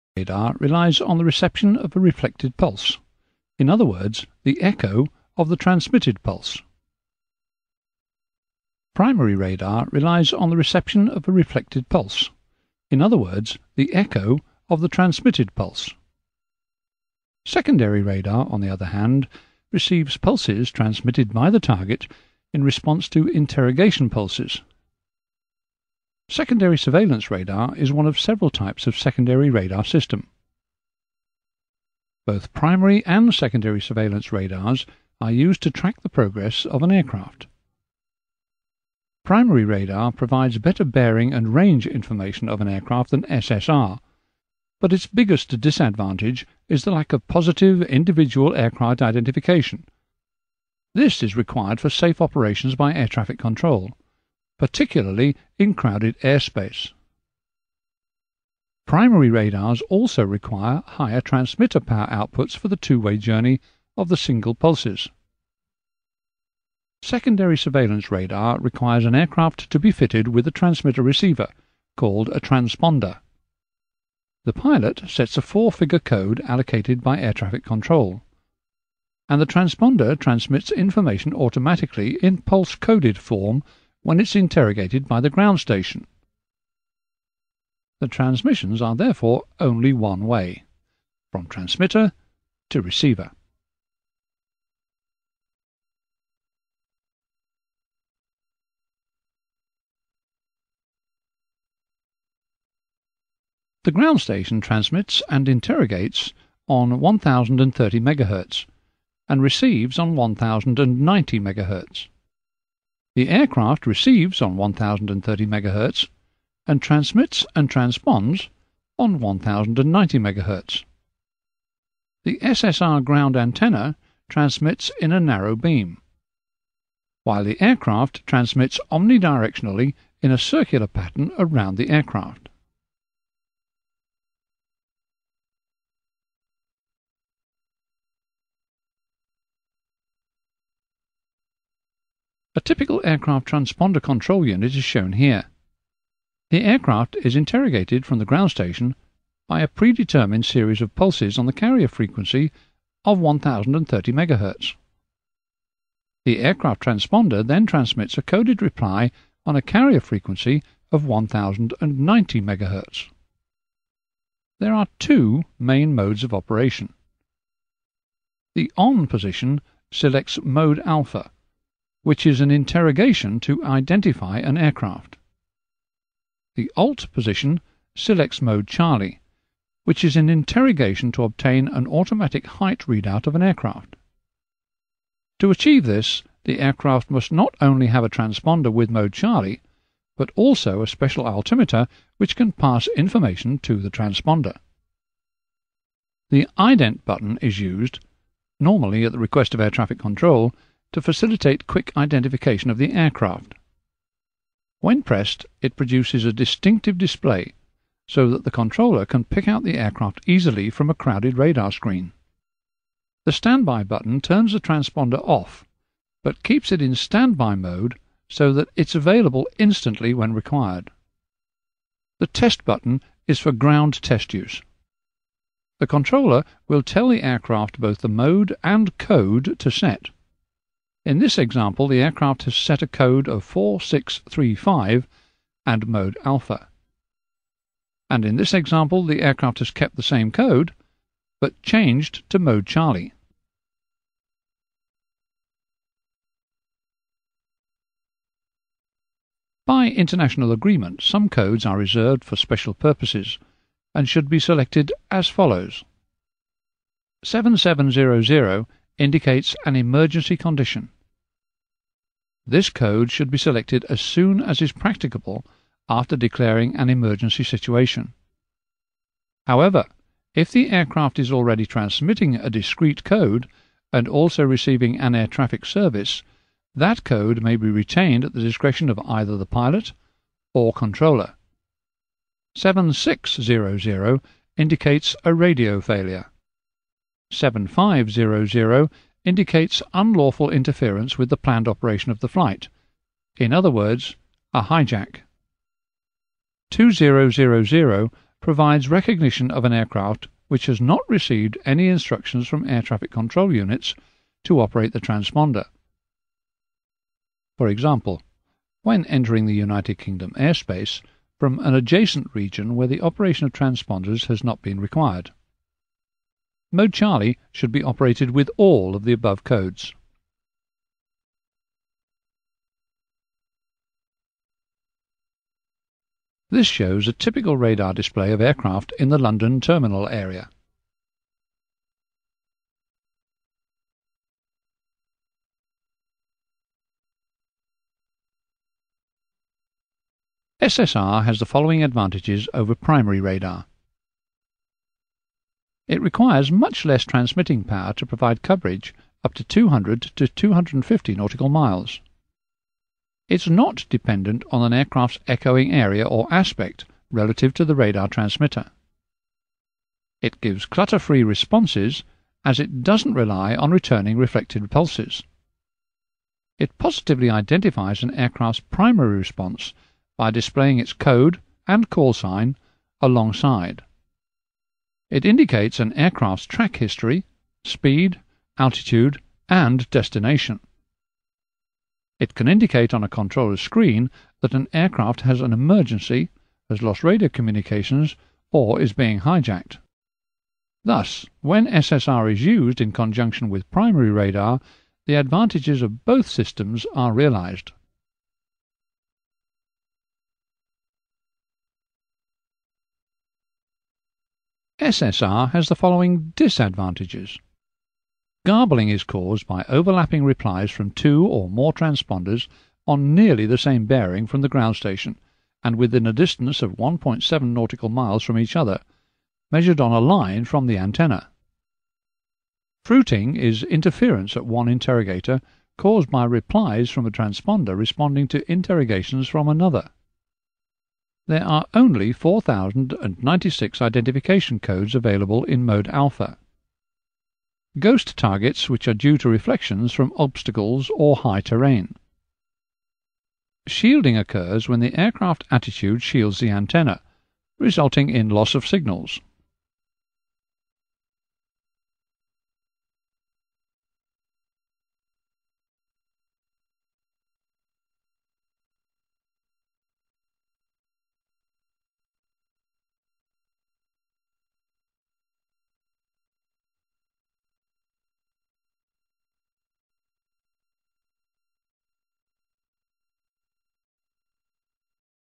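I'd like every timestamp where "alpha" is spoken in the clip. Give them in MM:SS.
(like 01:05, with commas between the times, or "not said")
02:50, 03:56, 07:15.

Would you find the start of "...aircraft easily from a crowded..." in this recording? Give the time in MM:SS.
03:29.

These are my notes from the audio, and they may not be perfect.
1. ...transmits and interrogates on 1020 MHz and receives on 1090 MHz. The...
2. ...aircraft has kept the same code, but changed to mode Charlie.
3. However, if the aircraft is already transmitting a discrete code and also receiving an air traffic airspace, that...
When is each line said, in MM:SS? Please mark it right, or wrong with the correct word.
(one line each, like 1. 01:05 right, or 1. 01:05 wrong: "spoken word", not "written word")
1. 01:44 wrong: "1030", not "1020"
2. 03:59 right
3. 04:29 wrong: "service", not "airspace".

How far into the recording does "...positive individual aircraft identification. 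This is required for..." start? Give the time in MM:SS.
00:47.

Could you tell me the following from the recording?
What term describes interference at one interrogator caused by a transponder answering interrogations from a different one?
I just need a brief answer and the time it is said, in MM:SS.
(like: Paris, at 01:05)
Fruiting, at 07:02.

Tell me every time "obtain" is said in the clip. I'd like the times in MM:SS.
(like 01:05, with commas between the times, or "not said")
03:01.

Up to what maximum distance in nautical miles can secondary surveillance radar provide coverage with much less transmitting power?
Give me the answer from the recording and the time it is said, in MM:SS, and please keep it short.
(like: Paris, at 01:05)
250 nautical miles, at 05:50.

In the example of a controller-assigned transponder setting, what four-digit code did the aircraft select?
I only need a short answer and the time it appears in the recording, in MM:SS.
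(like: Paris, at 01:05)
4635, at 03:53.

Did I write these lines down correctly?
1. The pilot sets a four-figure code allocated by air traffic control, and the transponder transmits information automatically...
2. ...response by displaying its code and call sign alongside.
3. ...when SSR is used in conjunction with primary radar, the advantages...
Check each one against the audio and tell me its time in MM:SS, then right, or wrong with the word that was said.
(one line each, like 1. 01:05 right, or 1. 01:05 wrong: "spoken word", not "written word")
1. 01:14 right
2. 06:09 right
3. 06:31 right.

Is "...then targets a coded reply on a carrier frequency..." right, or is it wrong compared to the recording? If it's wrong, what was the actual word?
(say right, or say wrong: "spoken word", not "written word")
wrong: "transmits", not "targets".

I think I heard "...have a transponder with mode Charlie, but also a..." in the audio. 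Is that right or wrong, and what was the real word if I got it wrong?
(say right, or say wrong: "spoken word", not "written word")
right.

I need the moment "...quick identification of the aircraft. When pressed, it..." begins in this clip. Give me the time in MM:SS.
03:21.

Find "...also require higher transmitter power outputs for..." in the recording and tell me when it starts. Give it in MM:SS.
00:59.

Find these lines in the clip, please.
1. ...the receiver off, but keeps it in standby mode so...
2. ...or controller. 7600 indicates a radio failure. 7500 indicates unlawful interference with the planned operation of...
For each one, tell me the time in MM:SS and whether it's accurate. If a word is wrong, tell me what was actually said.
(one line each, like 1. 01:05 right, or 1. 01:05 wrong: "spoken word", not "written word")
1. 03:34 wrong: "transponder", not "receiver"
2. 04:40 right.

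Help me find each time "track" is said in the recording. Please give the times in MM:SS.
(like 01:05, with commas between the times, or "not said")
00:35, 06:16.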